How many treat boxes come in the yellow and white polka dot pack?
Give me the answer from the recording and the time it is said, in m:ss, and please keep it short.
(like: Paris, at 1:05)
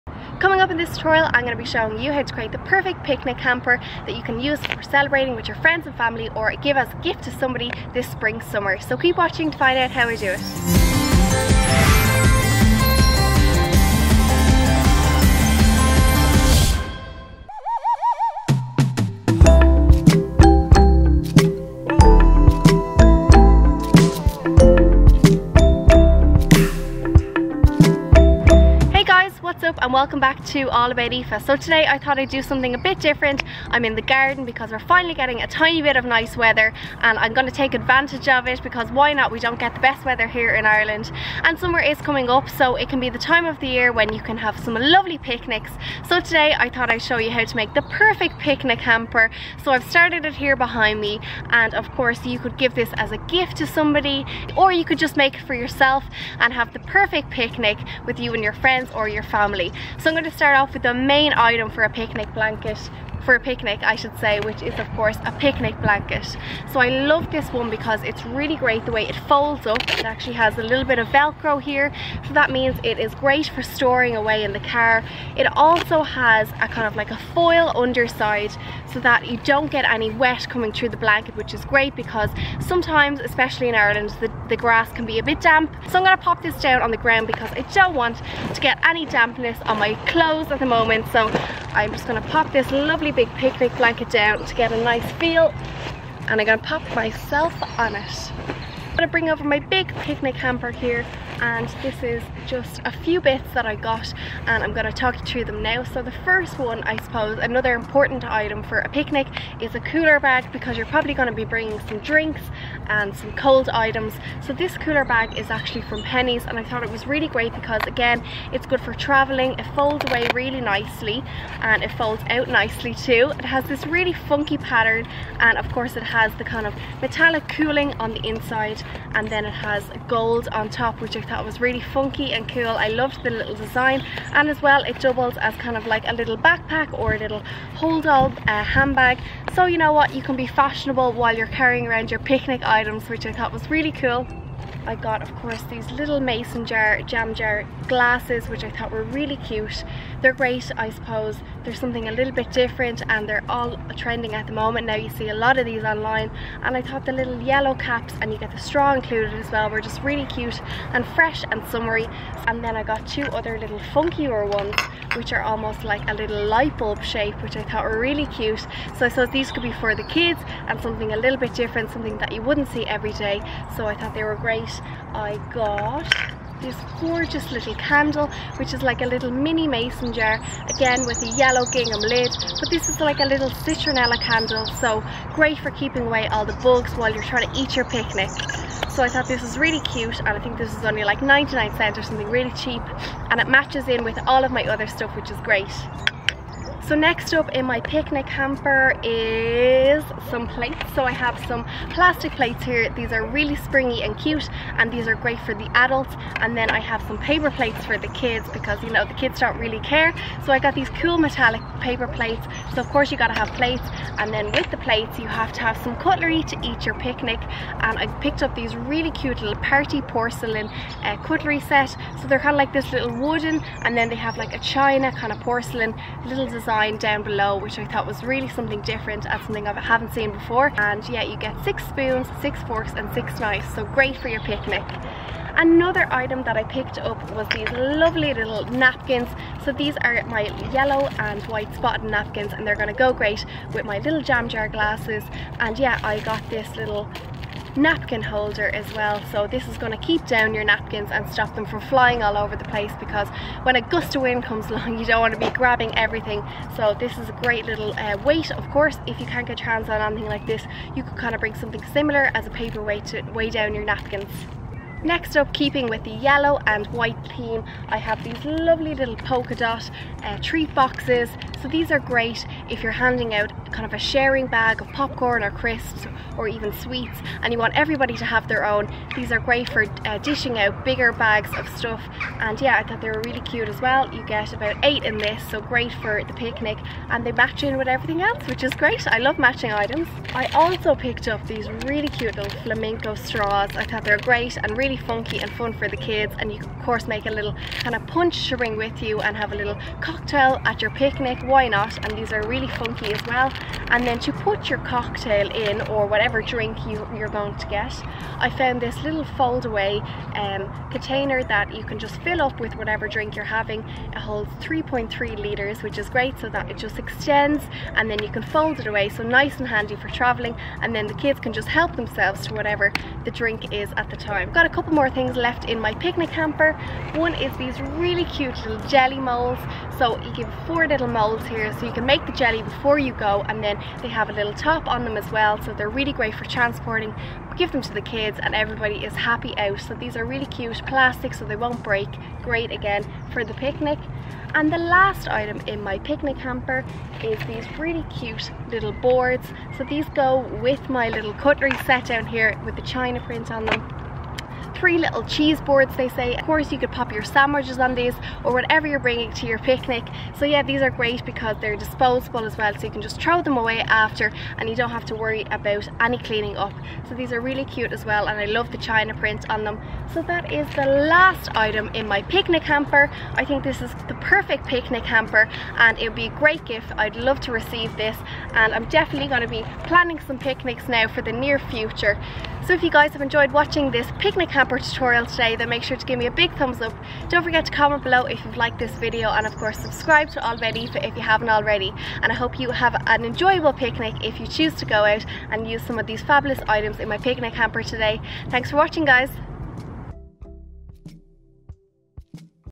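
8, at 4:44.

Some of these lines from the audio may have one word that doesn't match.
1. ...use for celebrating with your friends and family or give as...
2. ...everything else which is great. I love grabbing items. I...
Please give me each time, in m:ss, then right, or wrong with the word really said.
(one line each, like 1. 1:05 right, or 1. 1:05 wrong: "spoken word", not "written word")
1. 0:04 right
2. 4:47 wrong: "matching", not "grabbing".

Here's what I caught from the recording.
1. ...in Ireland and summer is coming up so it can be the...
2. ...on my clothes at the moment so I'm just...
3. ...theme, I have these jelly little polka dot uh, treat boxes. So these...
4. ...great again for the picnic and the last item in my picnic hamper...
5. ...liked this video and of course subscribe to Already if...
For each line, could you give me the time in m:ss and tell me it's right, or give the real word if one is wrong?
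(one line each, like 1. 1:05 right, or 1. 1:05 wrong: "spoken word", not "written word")
1. 0:40 right
2. 1:29 right
3. 4:27 wrong: "lovely", not "jelly"
4. 5:42 right
5. 6:28 right.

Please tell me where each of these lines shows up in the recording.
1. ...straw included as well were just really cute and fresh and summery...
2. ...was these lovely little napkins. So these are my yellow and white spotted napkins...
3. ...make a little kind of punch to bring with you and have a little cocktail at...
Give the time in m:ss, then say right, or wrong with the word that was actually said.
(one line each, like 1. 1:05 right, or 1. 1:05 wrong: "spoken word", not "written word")
1. 2:38 right
2. 3:57 right
3. 4:57 right.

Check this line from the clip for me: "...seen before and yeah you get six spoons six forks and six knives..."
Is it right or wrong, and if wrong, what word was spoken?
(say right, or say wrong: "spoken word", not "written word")
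right.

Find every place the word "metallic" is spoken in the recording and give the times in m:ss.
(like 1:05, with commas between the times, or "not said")
2:07, 3:31.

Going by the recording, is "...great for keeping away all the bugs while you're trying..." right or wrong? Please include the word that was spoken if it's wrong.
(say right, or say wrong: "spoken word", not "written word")
right.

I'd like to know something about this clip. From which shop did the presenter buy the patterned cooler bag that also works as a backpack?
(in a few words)
Penneys.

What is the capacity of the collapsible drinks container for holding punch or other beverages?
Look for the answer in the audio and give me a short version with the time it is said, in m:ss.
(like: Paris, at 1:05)
3.3 litres, at 5:14.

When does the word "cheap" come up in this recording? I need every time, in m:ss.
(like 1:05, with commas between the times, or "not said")
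3:12.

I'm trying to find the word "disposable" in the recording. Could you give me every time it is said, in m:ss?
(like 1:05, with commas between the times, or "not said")
6:01.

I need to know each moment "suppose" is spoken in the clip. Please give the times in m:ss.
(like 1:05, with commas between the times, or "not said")
1:47, 2:30.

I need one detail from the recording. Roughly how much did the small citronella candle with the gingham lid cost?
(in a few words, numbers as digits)
99 cents.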